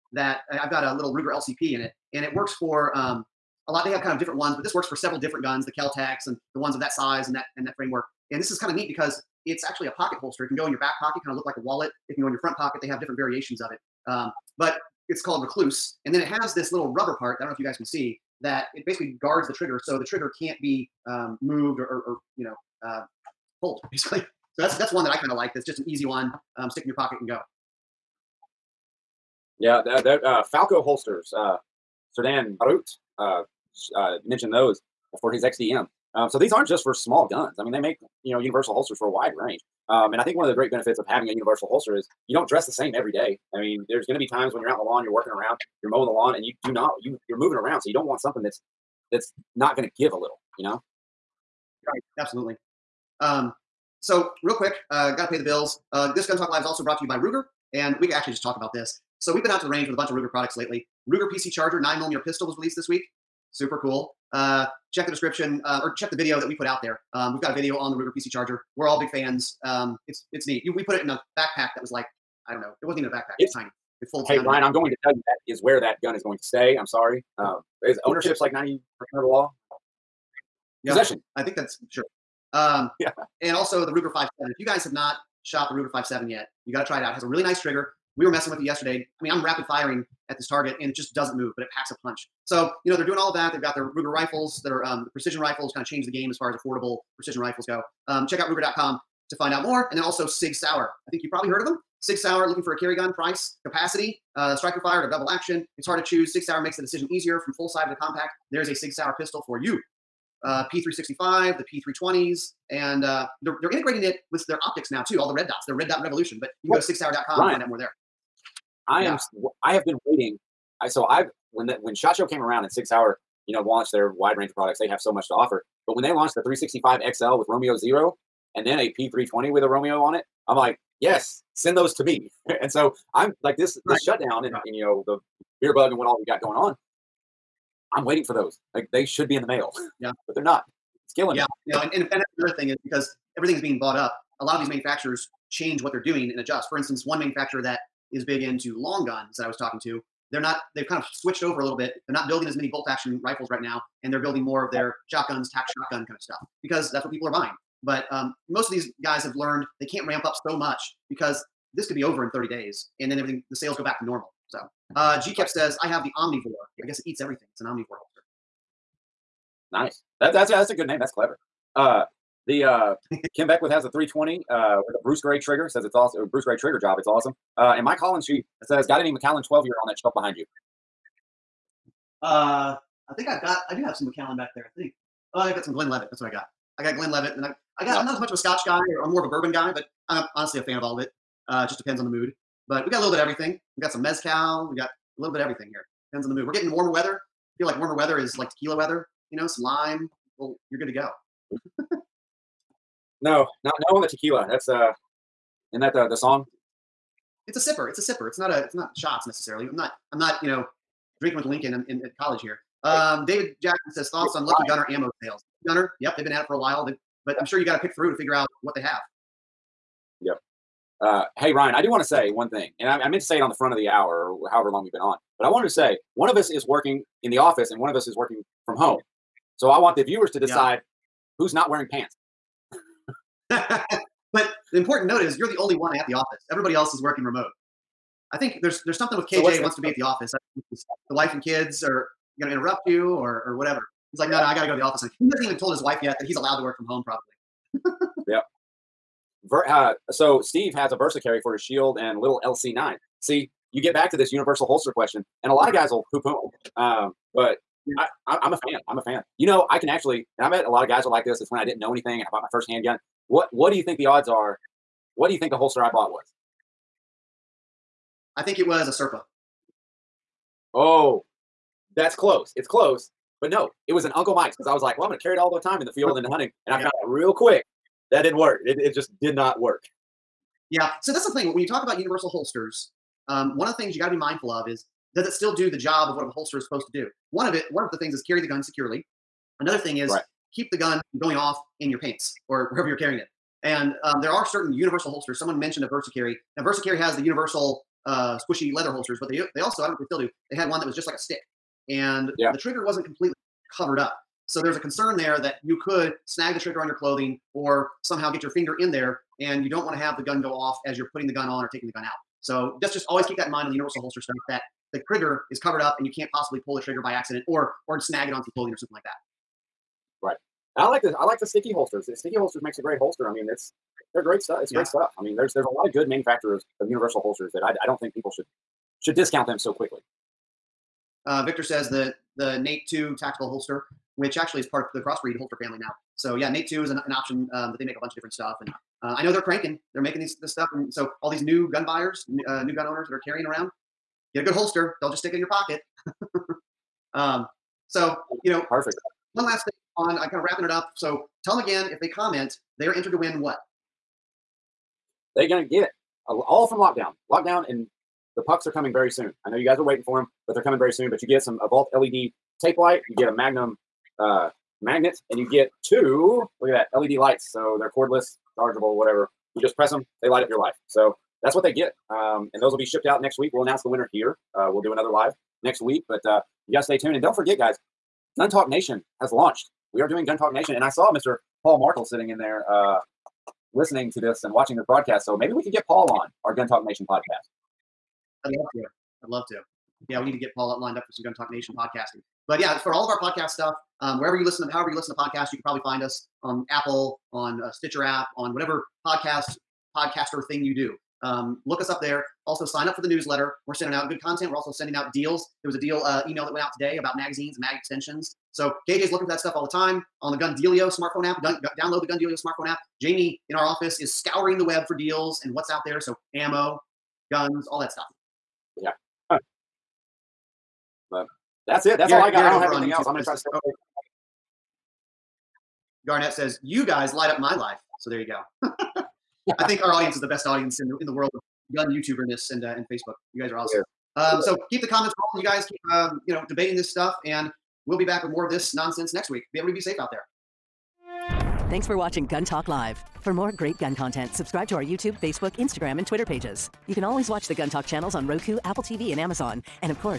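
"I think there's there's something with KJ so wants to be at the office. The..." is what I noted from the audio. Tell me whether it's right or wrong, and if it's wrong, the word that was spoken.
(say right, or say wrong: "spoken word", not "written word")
right.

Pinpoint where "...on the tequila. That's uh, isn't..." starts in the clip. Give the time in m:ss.
3:23.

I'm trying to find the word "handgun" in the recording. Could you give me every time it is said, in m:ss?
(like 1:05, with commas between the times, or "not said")
4:22.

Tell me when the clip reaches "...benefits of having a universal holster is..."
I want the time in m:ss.
0:40.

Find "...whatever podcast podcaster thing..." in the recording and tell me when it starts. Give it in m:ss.
6:38.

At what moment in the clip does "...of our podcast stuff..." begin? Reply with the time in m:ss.
6:33.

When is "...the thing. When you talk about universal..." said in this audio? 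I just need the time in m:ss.
4:41.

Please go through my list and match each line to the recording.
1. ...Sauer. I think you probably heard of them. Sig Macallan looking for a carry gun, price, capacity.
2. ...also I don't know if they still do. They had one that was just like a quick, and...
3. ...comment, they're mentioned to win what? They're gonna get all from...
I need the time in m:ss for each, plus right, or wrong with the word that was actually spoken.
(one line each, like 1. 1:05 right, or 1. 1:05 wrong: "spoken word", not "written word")
1. 1:40 wrong: "Sauer", not "Macallan"
2. 4:59 wrong: "stick", not "quick"
3. 5:52 wrong: "entered", not "mentioned".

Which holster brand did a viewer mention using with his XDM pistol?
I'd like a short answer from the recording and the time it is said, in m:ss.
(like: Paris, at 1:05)
Falco, at 0:30.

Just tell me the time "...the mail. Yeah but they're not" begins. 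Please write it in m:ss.
2:19.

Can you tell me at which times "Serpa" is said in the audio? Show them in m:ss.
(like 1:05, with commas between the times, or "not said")
4:28.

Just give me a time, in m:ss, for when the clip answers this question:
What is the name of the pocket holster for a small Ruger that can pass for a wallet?
0:15.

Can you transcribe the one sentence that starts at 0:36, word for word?
Um, so these aren't just for small guns.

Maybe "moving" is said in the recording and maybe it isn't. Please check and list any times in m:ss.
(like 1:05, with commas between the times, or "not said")
0:47.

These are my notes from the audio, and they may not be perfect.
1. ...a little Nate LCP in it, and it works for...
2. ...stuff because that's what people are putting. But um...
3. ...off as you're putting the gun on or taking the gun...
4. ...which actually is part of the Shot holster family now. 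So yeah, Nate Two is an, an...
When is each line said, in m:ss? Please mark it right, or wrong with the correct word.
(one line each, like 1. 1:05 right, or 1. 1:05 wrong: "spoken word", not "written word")
1. 0:00 wrong: "Ruger", not "Nate"
2. 2:36 wrong: "buying", not "putting"
3. 5:10 right
4. 5:34 wrong: "Crossbreed", not "Shot".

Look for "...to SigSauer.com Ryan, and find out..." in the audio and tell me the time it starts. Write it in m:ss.
1:56.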